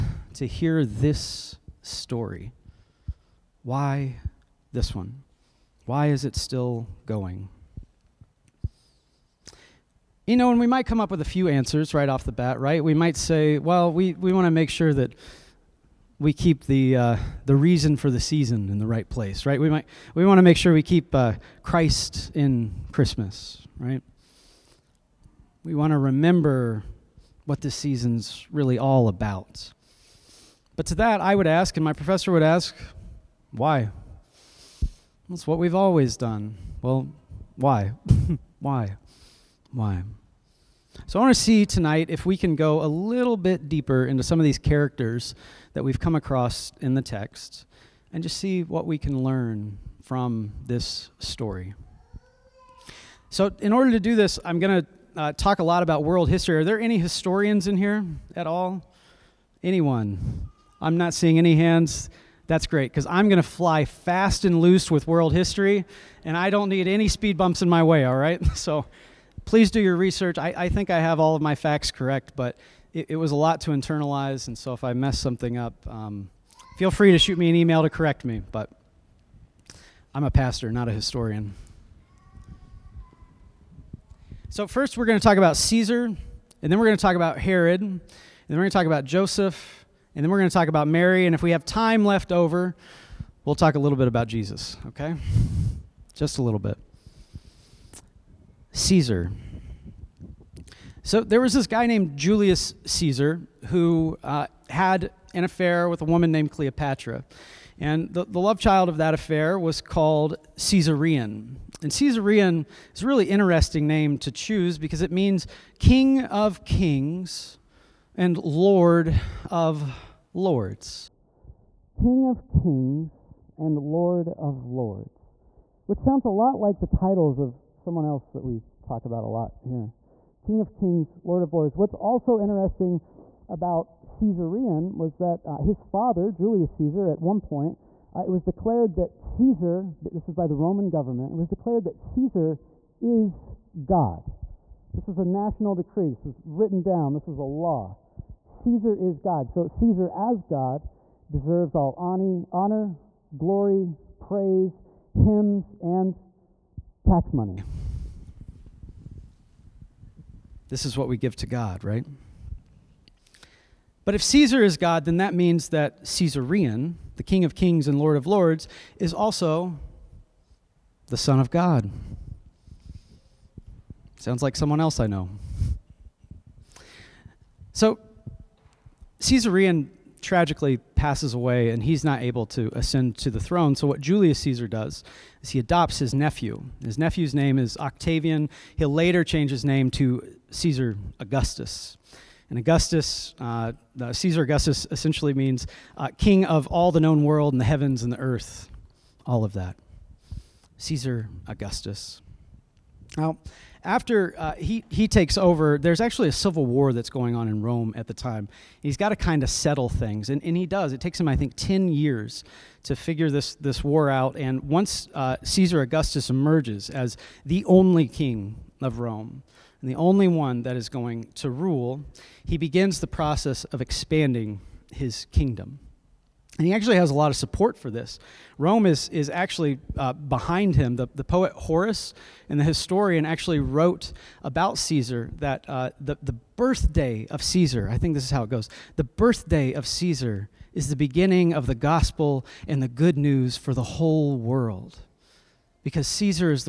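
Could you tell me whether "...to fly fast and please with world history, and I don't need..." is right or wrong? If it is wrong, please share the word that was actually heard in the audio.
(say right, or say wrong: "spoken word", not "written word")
wrong: "loose", not "please".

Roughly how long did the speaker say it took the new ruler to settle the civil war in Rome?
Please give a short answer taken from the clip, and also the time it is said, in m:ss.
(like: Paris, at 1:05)
10 years, at 3:31.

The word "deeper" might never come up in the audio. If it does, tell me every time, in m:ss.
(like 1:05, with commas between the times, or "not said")
0:43.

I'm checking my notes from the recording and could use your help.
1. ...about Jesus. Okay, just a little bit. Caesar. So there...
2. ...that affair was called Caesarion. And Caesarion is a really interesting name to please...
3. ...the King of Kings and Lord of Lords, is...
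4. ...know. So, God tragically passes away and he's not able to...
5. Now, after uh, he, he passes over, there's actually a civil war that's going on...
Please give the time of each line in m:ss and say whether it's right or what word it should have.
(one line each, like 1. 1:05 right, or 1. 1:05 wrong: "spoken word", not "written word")
1. 1:34 right
2. 1:48 wrong: "choose", not "please"
3. 2:47 right
4. 2:55 wrong: "Caesarion", not "God"
5. 3:23 wrong: "takes", not "passes".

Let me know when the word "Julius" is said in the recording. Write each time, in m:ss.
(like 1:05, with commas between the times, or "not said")
1:42, 2:16, 3:03.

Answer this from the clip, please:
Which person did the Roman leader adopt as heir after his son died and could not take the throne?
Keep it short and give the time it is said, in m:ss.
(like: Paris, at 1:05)
Octavian, at 3:07.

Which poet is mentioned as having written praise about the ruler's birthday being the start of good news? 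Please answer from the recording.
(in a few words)
Horace.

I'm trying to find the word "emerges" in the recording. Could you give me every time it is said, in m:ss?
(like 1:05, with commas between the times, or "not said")
3:36.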